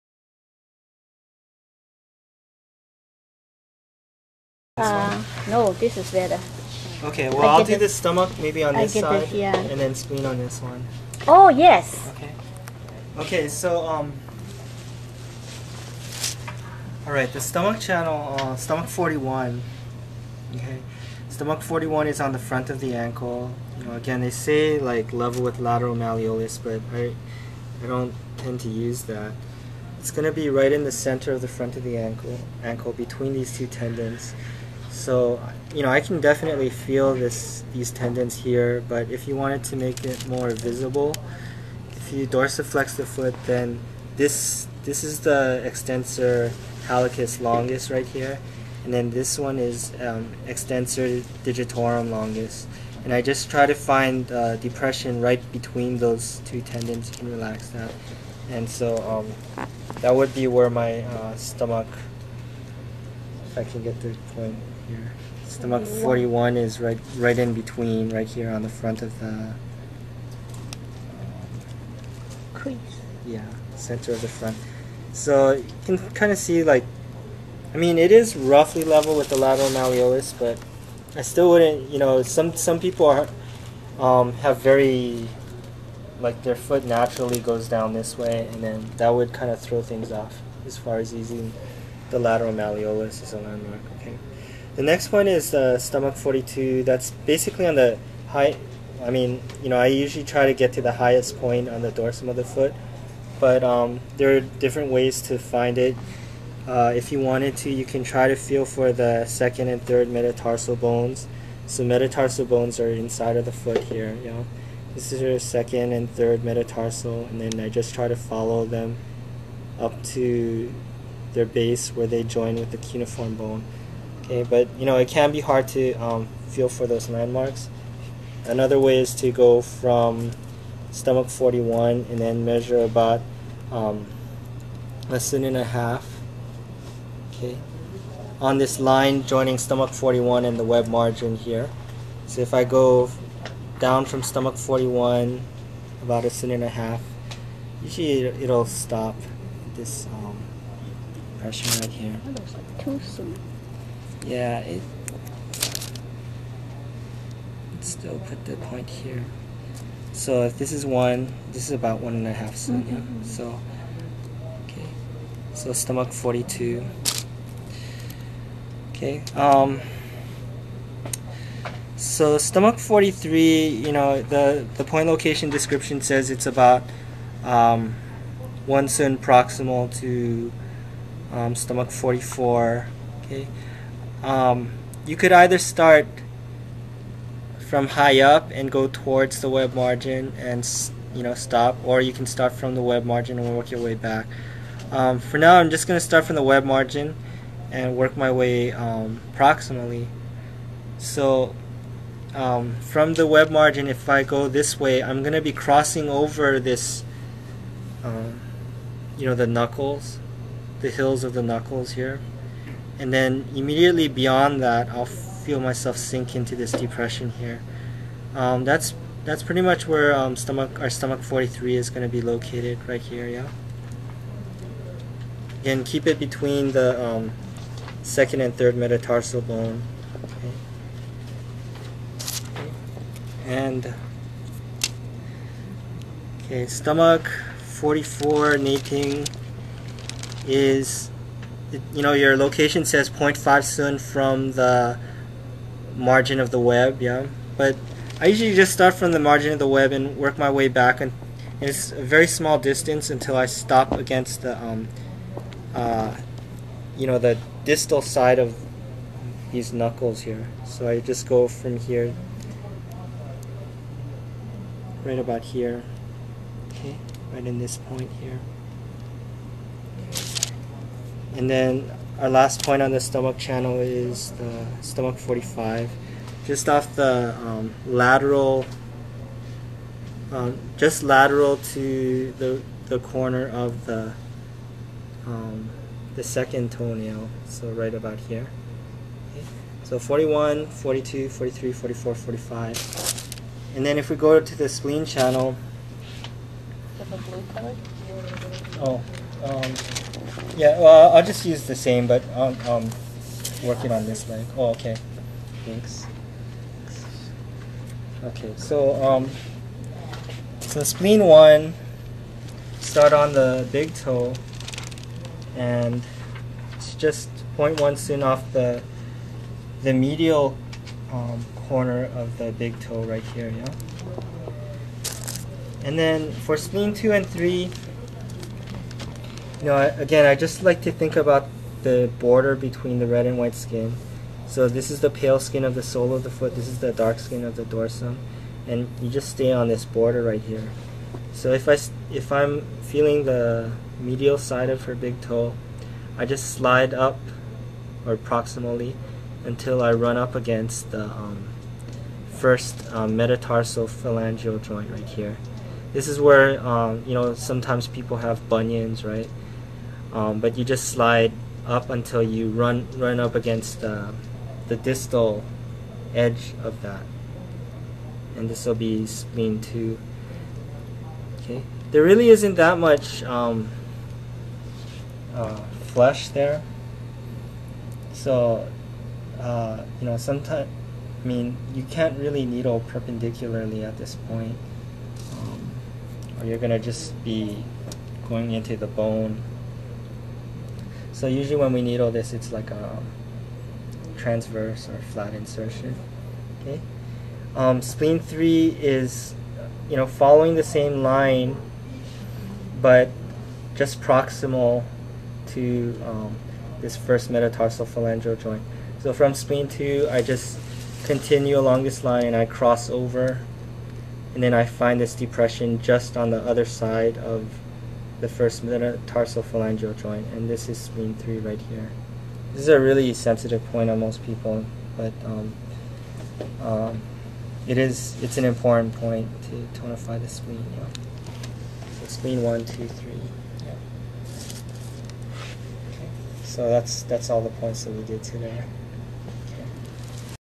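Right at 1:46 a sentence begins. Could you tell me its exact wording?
Uh, if you wanted to, you can try to feel for the second and third metatarsal bones.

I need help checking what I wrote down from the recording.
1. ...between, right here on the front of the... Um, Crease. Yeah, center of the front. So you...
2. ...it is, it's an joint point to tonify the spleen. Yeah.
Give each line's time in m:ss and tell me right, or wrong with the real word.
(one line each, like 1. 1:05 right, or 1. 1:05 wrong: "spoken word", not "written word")
1. 1:07 right
2. 7:07 wrong: "important", not "joint".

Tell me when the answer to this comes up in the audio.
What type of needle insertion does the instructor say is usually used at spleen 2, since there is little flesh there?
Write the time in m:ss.
6:34.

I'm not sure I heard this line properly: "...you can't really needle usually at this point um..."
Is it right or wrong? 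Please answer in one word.
wrong.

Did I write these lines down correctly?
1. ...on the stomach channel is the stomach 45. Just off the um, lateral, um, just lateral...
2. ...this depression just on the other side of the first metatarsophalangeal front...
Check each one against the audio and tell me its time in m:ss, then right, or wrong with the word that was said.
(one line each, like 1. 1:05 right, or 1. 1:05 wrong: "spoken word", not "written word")
1. 4:32 right
2. 6:54 wrong: "joint", not "front".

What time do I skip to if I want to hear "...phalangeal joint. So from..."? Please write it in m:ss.
6:47.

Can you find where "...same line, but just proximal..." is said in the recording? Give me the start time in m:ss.
6:40.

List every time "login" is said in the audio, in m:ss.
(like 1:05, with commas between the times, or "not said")
not said.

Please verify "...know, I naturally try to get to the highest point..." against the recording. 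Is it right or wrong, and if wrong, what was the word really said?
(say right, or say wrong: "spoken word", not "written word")
wrong: "usually", not "naturally".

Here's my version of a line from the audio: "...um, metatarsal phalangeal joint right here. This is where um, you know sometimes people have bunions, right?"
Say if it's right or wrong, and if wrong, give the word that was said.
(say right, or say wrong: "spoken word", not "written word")
right.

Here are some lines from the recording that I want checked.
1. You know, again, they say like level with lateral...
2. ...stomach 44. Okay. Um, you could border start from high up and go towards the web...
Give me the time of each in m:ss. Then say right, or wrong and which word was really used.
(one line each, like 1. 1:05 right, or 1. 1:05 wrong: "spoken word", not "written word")
1. 0:23 right
2. 3:01 wrong: "either", not "border".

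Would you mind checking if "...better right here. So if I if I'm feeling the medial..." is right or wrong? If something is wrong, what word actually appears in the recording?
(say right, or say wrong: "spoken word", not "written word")
wrong: "border", not "better".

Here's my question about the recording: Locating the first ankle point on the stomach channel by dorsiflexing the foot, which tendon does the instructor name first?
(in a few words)
Extensor hallucis longus.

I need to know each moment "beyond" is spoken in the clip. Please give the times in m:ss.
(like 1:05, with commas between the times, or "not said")
3:34.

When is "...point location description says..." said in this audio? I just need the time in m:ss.
2:54.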